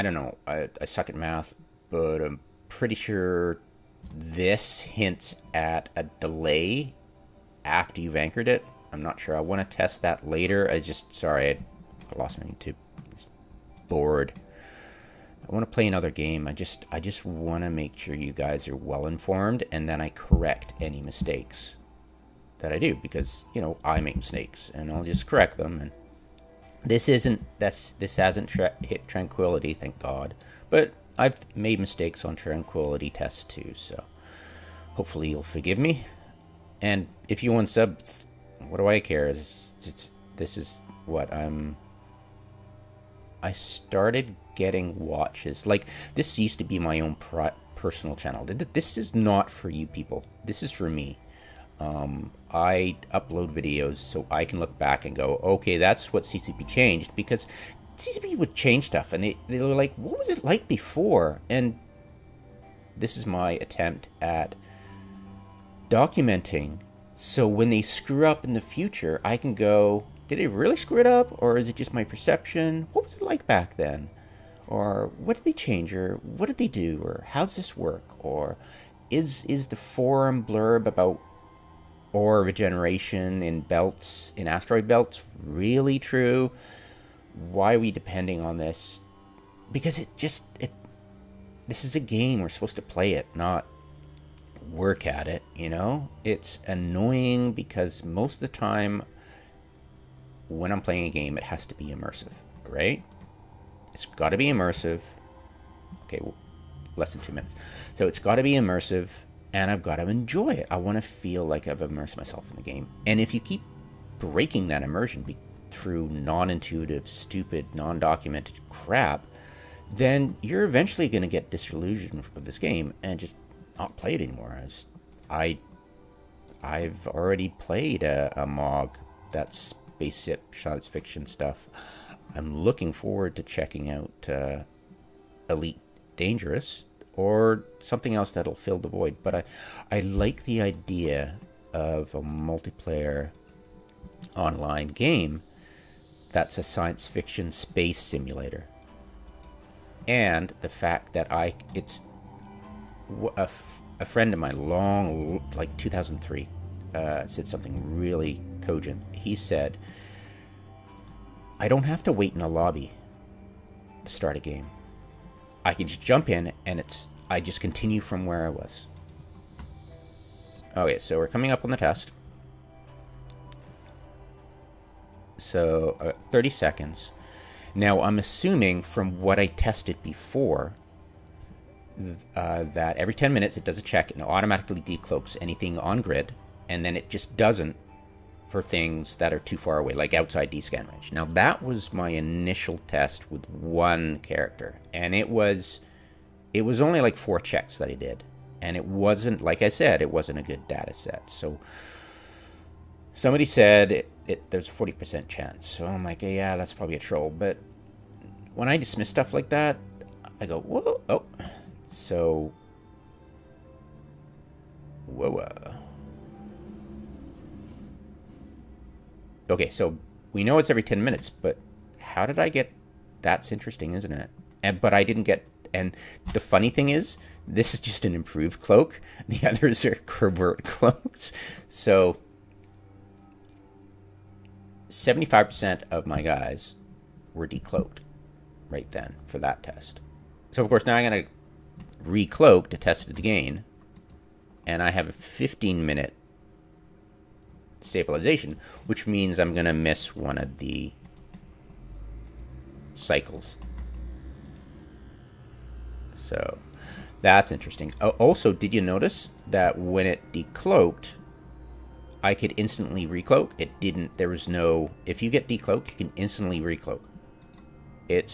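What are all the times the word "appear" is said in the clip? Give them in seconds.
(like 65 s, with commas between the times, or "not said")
not said.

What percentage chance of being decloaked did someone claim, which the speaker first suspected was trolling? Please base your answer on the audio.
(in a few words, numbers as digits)
40%.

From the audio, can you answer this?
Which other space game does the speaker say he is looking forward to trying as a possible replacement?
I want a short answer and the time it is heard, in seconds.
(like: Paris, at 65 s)
Elite Dangerous, at 135 s.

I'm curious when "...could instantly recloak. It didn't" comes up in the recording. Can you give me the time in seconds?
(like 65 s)
262 s.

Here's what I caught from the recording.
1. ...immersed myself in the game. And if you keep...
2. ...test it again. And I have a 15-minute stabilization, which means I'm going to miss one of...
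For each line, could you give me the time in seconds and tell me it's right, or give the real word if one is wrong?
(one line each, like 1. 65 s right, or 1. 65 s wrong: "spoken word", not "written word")
1. 111 s right
2. 242 s right.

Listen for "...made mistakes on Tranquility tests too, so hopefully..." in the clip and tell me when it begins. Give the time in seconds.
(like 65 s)
31 s.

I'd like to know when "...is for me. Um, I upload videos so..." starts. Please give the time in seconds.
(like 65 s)
50 s.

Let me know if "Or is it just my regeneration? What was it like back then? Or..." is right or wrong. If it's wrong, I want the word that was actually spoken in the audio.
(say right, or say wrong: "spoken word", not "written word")
wrong: "perception", not "regeneration".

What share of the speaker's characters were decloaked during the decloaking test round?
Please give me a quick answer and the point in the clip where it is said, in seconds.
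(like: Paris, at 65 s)
75%, at 234 s.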